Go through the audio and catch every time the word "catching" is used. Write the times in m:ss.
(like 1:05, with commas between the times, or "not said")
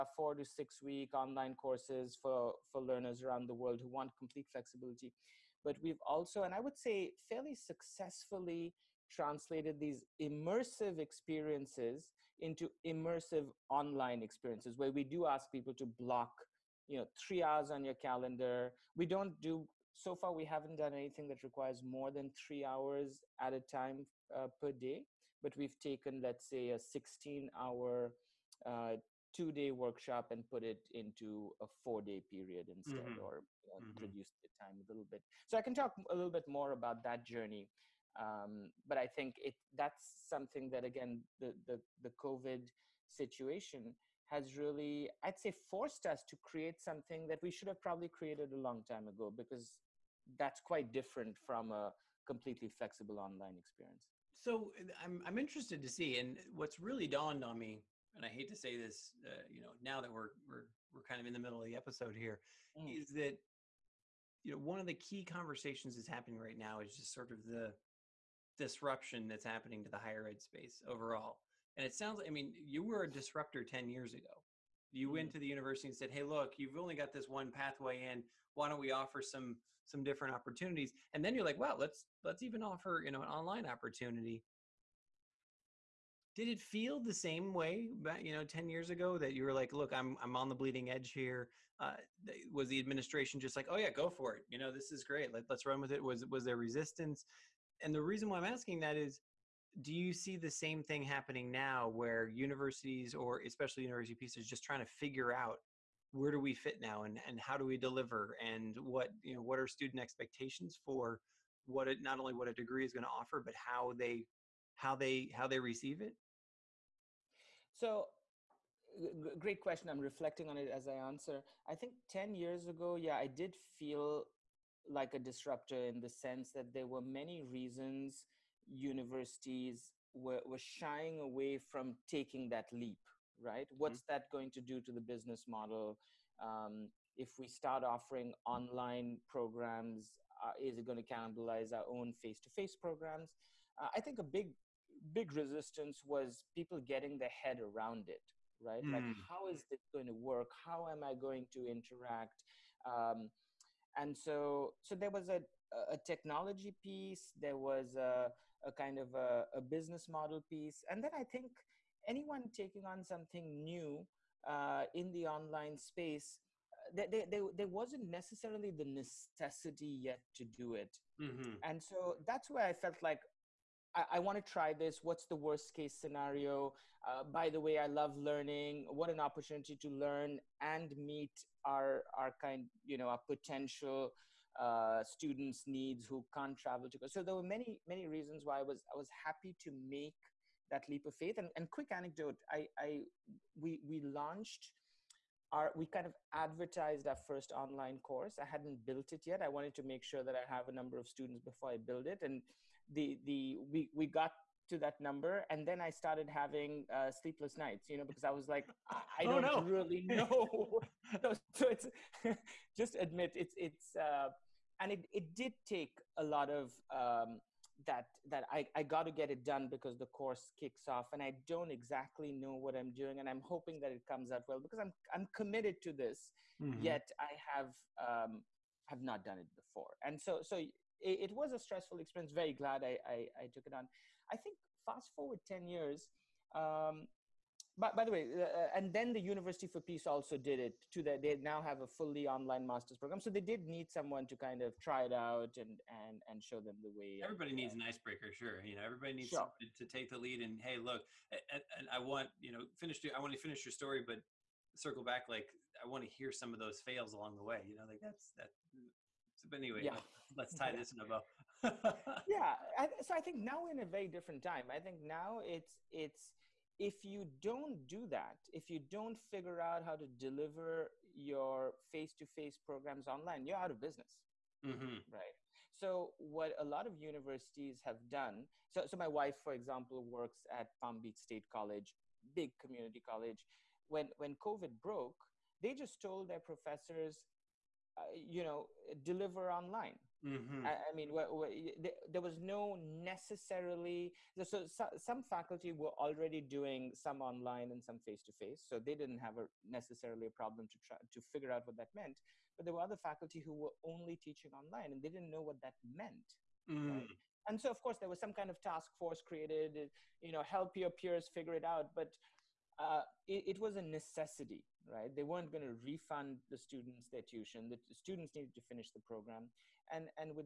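not said.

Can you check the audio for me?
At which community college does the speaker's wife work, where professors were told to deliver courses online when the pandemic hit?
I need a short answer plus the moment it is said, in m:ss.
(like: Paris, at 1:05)
Palm Beach State College, at 4:40.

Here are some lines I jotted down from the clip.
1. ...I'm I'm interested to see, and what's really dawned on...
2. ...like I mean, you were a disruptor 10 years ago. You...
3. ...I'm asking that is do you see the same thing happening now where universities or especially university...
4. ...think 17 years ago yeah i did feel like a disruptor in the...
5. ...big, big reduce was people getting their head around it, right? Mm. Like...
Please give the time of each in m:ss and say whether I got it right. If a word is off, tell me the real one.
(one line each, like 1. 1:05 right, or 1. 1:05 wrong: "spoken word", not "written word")
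1. 0:54 right
2. 1:12 right
3. 1:38 right
4. 2:01 wrong: "10", not "17"
5. 2:24 wrong: "resistance", not "reduce".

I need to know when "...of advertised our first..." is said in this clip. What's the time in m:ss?
3:16.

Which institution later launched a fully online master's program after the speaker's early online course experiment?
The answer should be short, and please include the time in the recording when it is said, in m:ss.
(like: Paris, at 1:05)
University for Peace, at 3:59.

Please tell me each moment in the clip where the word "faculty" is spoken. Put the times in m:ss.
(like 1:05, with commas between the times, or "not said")
4:55, 5:02.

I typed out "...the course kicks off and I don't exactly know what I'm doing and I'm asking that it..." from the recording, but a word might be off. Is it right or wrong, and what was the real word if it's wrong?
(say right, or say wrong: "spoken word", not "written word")
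wrong: "hoping", not "asking".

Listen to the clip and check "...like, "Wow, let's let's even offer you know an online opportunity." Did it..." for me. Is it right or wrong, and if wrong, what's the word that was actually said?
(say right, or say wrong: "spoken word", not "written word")
right.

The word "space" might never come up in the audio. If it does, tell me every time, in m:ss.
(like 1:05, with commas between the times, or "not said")
1:10, 2:45.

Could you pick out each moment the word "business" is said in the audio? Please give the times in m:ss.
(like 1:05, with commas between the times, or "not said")
2:15, 2:39, 4:33.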